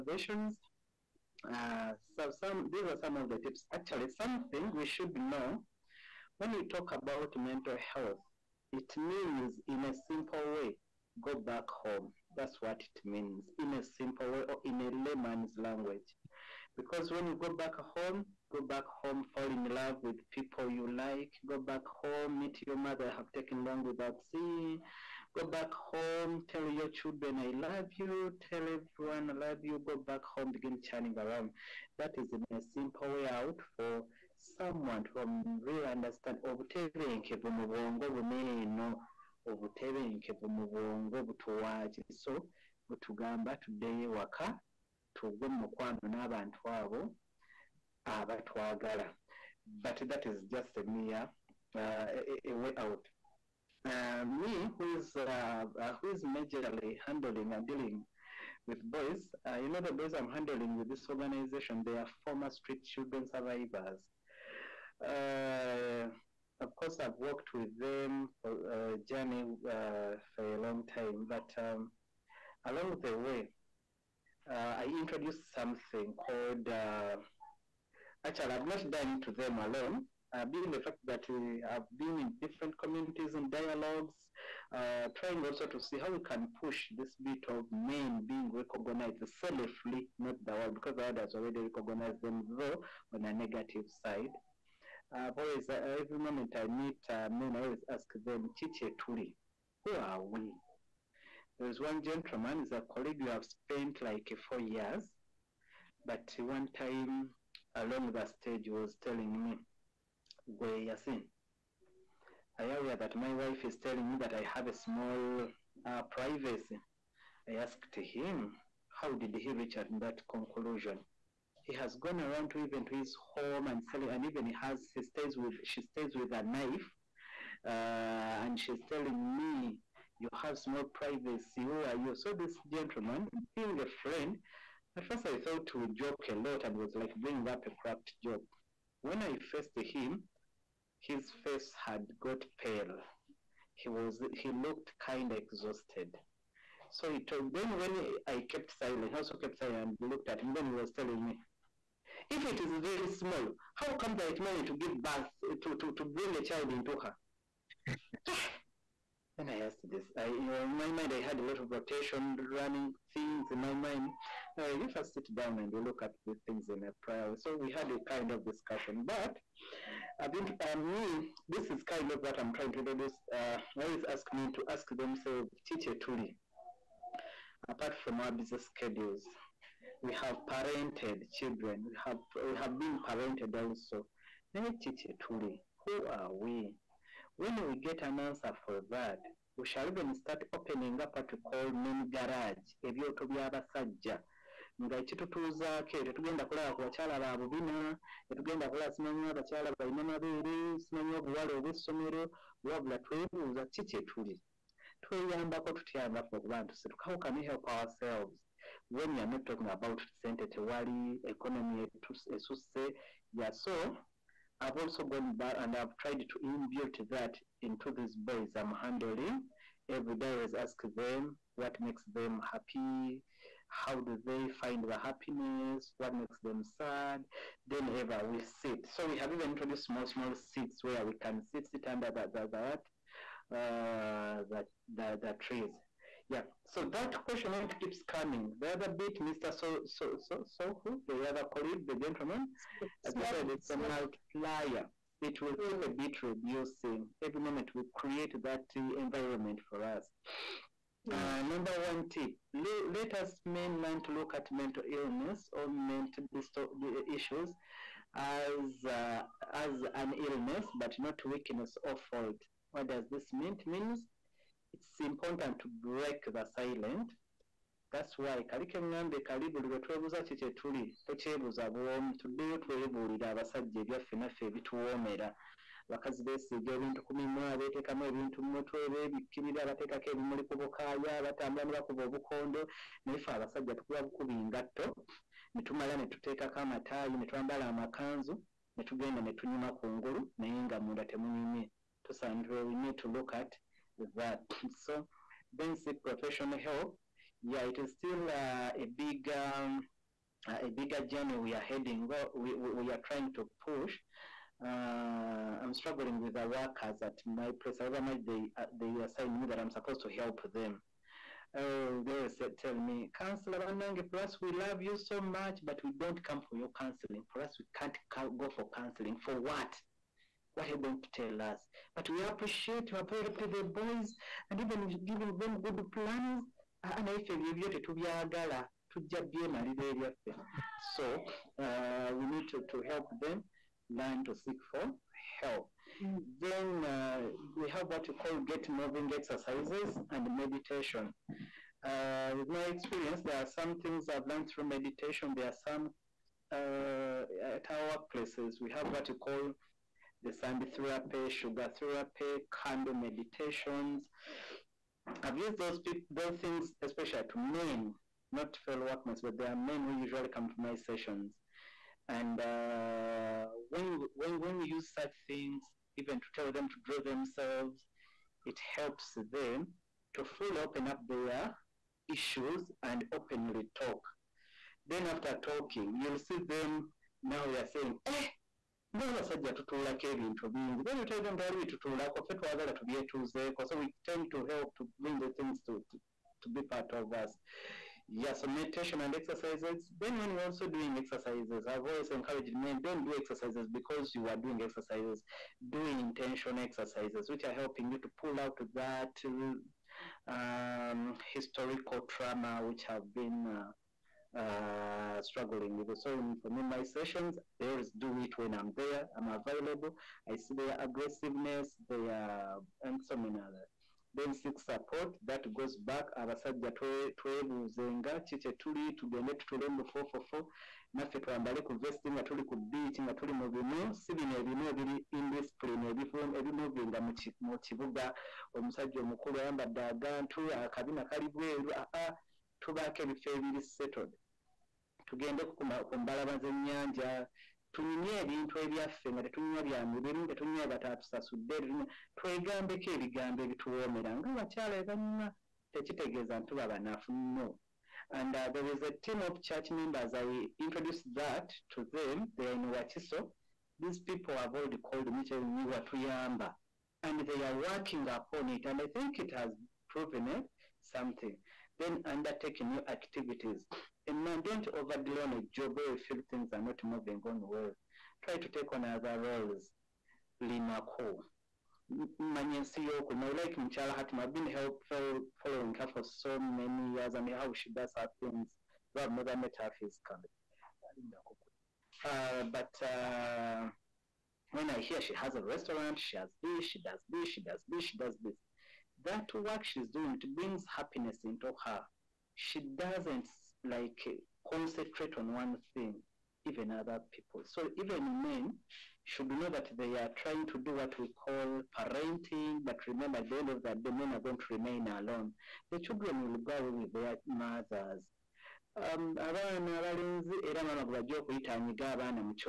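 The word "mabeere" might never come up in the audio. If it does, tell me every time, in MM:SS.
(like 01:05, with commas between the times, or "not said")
03:20.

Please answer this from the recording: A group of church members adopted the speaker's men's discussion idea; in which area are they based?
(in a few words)
Wakiso.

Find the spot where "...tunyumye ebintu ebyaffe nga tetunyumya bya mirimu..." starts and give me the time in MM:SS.
07:17.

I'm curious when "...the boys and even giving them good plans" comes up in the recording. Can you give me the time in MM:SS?
05:23.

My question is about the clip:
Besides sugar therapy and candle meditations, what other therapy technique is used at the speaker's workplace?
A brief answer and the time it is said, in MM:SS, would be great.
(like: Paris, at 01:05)
Sand therapy, at 05:50.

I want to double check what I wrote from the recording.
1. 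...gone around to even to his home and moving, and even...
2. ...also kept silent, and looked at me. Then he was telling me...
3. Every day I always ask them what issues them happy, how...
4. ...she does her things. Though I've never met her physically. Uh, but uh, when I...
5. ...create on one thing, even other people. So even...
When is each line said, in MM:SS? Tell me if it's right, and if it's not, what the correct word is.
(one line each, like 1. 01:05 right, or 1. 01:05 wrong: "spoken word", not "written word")
1. 02:02 wrong: "selling", not "moving"
2. 02:29 right
3. 03:39 wrong: "makes", not "issues"
4. 07:57 right
5. 08:14 wrong: "concentrate", not "create".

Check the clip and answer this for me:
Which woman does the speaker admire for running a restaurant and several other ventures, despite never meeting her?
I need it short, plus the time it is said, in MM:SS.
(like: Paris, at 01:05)
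Mchala Hatim, at 07:53.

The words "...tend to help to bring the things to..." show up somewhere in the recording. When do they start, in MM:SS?
06:24.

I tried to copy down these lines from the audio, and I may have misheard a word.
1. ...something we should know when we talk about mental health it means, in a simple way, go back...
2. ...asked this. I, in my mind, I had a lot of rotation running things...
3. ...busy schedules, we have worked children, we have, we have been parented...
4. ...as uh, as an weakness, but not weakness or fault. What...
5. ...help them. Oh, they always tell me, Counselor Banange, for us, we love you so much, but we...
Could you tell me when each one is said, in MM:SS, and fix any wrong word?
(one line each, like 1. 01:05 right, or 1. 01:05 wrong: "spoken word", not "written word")
1. 00:04 right
2. 02:39 right
3. 02:58 wrong: "parented", not "worked"
4. 04:18 wrong: "illness", not "weakness"
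5. 05:10 right.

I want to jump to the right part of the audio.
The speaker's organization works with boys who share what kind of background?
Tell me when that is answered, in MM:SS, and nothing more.
01:02.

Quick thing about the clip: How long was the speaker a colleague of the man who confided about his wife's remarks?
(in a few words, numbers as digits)
Four years.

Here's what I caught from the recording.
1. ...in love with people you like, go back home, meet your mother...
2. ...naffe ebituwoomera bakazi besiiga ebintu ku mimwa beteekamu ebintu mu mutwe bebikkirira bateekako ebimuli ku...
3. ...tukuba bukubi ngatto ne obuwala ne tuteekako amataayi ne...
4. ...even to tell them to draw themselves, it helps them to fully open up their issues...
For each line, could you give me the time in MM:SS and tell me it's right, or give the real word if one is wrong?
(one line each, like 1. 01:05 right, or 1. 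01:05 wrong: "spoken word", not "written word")
1. 00:19 right
2. 04:34 right
3. 04:43 wrong: "tumala", not "obuwala"
4. 06:05 right.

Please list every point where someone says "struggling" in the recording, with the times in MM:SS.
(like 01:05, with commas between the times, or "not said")
05:05, 06:45.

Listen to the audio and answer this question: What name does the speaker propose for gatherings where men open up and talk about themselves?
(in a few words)
Men garage.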